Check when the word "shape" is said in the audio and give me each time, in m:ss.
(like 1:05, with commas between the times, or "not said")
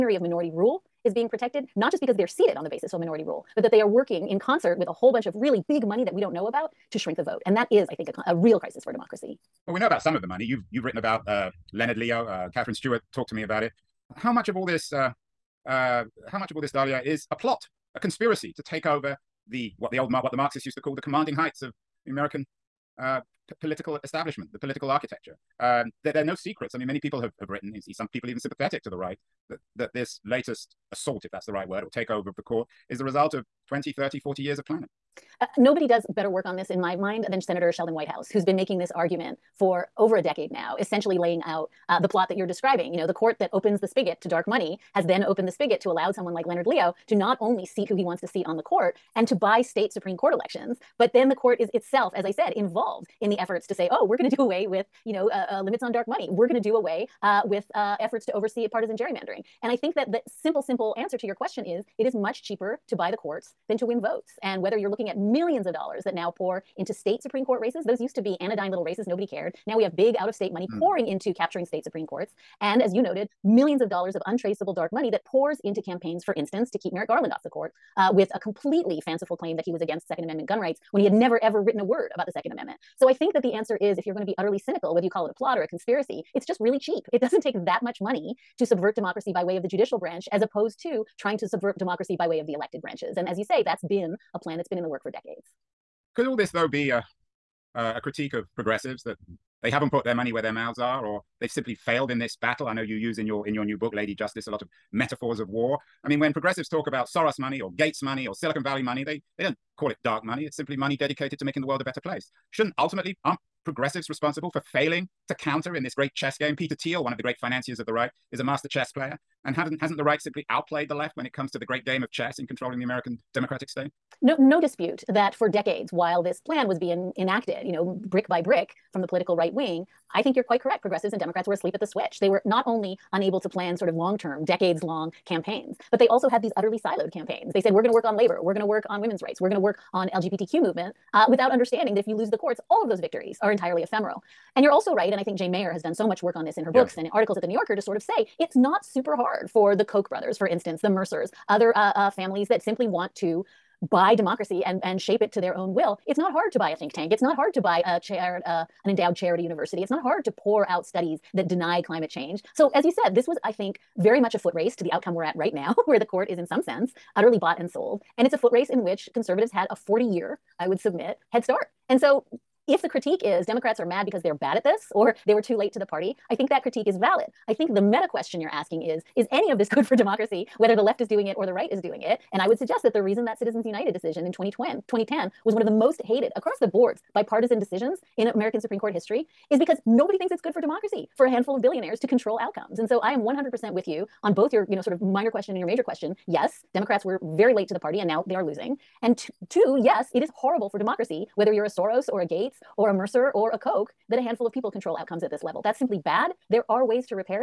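2:34.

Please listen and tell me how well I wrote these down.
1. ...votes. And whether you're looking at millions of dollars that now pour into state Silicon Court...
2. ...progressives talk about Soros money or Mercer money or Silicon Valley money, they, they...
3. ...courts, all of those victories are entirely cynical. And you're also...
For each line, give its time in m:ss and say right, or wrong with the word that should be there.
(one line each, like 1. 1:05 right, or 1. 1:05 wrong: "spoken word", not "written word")
1. 1:04 wrong: "Supreme", not "Silicon"
2. 1:46 wrong: "Gates", not "Mercer"
3. 2:22 wrong: "ephemeral", not "cynical".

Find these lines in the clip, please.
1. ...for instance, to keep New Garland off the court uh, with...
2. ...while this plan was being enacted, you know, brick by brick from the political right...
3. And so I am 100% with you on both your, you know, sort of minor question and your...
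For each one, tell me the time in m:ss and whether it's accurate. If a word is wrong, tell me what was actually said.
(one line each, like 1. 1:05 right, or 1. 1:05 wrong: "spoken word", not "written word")
1. 1:16 wrong: "Merrick", not "New"
2. 2:05 right
3. 3:12 right.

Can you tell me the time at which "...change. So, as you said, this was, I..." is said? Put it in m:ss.
2:42.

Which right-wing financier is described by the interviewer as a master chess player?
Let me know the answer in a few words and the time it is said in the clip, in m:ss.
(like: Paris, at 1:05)
Peter Thiel, at 1:56.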